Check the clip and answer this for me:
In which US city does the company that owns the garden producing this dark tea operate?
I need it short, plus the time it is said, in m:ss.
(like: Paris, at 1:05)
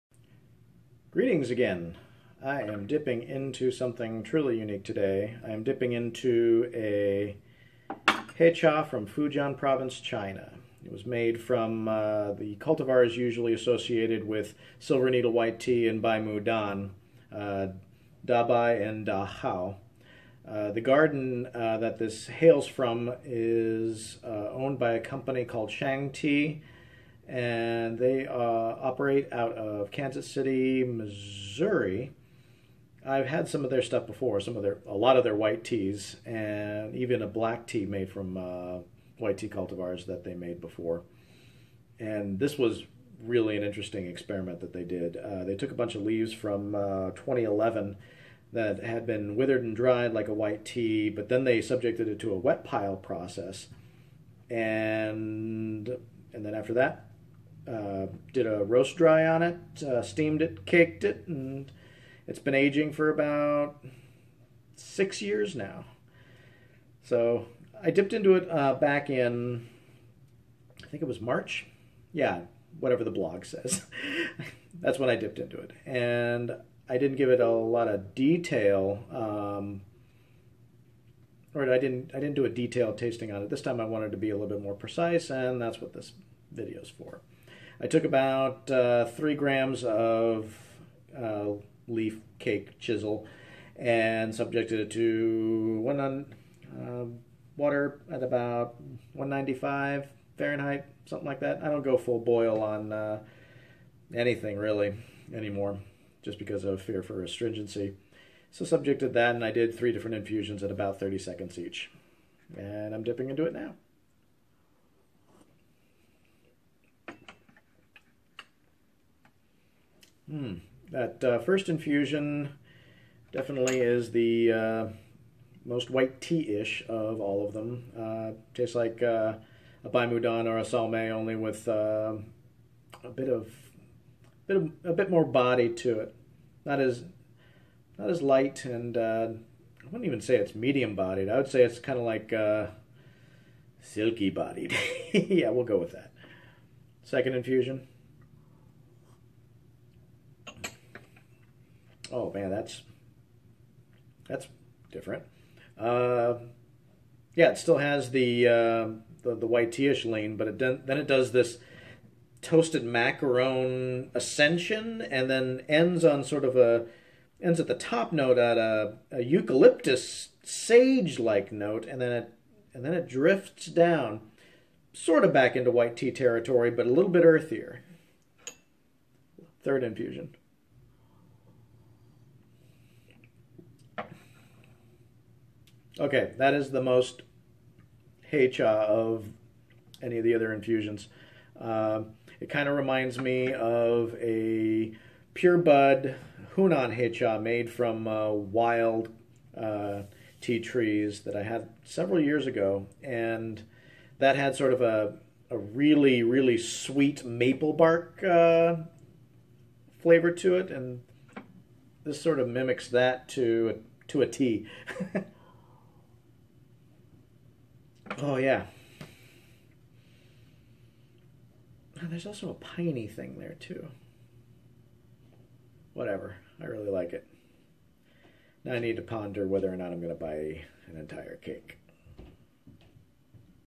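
Kansas City, Missouri, at 0:29.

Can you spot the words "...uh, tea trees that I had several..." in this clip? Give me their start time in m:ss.
3:19.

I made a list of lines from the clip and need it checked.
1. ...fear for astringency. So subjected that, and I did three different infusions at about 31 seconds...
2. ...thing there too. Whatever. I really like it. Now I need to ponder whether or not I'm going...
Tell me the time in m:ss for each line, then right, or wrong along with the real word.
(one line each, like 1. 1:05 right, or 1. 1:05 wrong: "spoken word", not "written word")
1. 1:46 wrong: "30", not "31"
2. 3:43 right.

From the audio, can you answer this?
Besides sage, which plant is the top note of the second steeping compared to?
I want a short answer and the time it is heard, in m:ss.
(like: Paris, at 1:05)
Eucalyptus, at 2:49.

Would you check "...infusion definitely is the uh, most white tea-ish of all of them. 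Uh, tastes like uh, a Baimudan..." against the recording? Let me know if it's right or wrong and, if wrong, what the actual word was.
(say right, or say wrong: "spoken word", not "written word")
right.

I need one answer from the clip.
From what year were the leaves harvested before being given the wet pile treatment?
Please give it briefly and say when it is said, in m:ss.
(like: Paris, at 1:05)
2011, at 0:47.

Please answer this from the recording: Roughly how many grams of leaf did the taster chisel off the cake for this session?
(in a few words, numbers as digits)
3 grams.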